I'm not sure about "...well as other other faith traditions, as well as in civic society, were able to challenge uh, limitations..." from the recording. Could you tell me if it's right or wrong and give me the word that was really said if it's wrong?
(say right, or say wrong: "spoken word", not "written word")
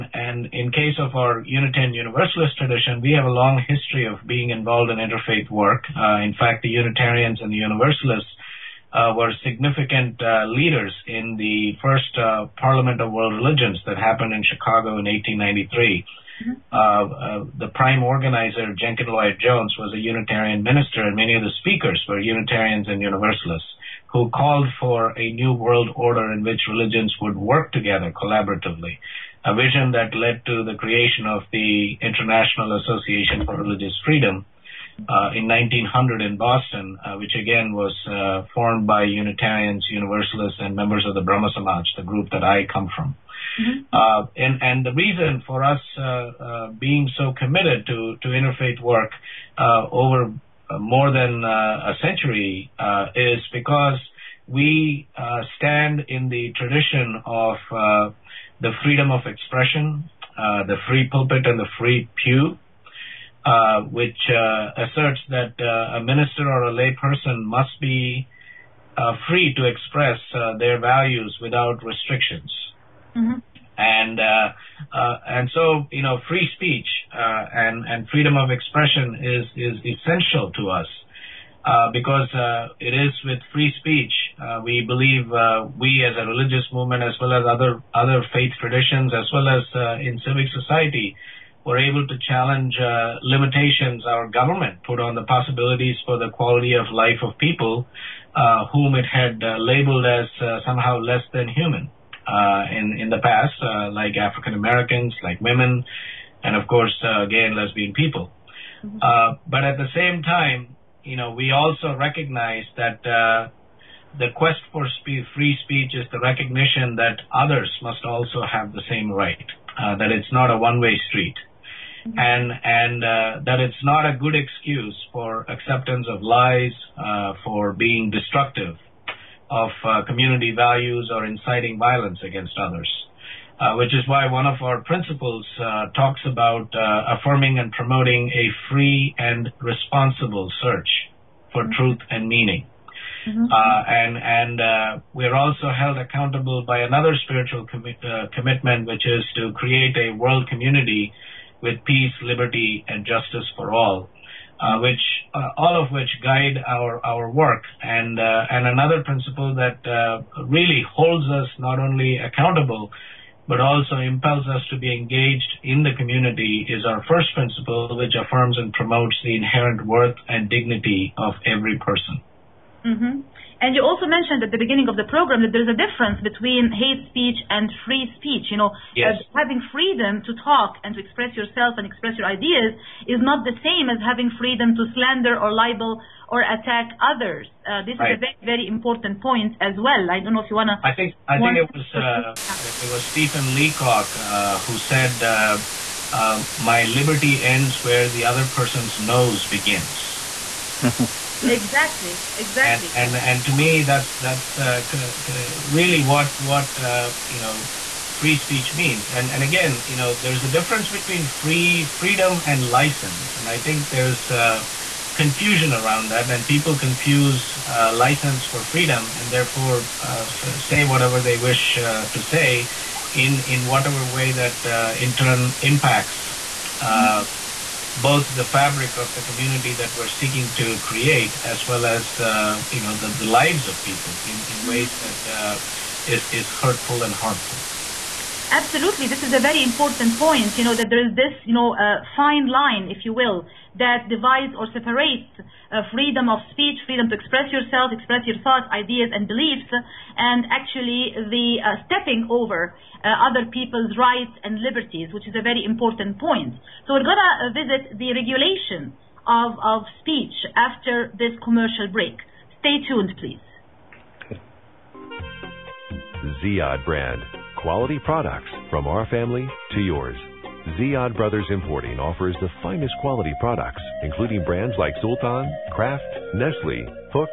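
right.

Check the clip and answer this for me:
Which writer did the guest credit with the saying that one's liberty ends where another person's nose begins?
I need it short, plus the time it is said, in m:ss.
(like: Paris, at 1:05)
Stephen Leacock, at 3:13.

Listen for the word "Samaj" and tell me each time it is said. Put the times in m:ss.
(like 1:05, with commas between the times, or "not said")
0:41.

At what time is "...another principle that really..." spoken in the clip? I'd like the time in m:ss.
2:38.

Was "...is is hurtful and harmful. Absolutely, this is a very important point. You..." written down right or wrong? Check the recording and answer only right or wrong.
right.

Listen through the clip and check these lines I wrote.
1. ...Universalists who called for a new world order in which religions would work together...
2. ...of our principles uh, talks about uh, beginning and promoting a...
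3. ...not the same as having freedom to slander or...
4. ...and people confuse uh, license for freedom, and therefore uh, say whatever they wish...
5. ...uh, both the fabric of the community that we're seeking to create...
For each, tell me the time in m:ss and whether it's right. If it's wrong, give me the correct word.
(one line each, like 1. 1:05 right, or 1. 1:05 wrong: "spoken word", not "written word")
1. 0:23 right
2. 2:14 wrong: "affirming", not "beginning"
3. 3:03 right
4. 3:36 right
5. 3:46 right.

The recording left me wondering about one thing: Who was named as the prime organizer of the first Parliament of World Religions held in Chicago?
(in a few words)
Jenkin Lloyd Jones.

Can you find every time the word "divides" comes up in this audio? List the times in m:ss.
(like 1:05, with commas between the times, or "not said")
4:04.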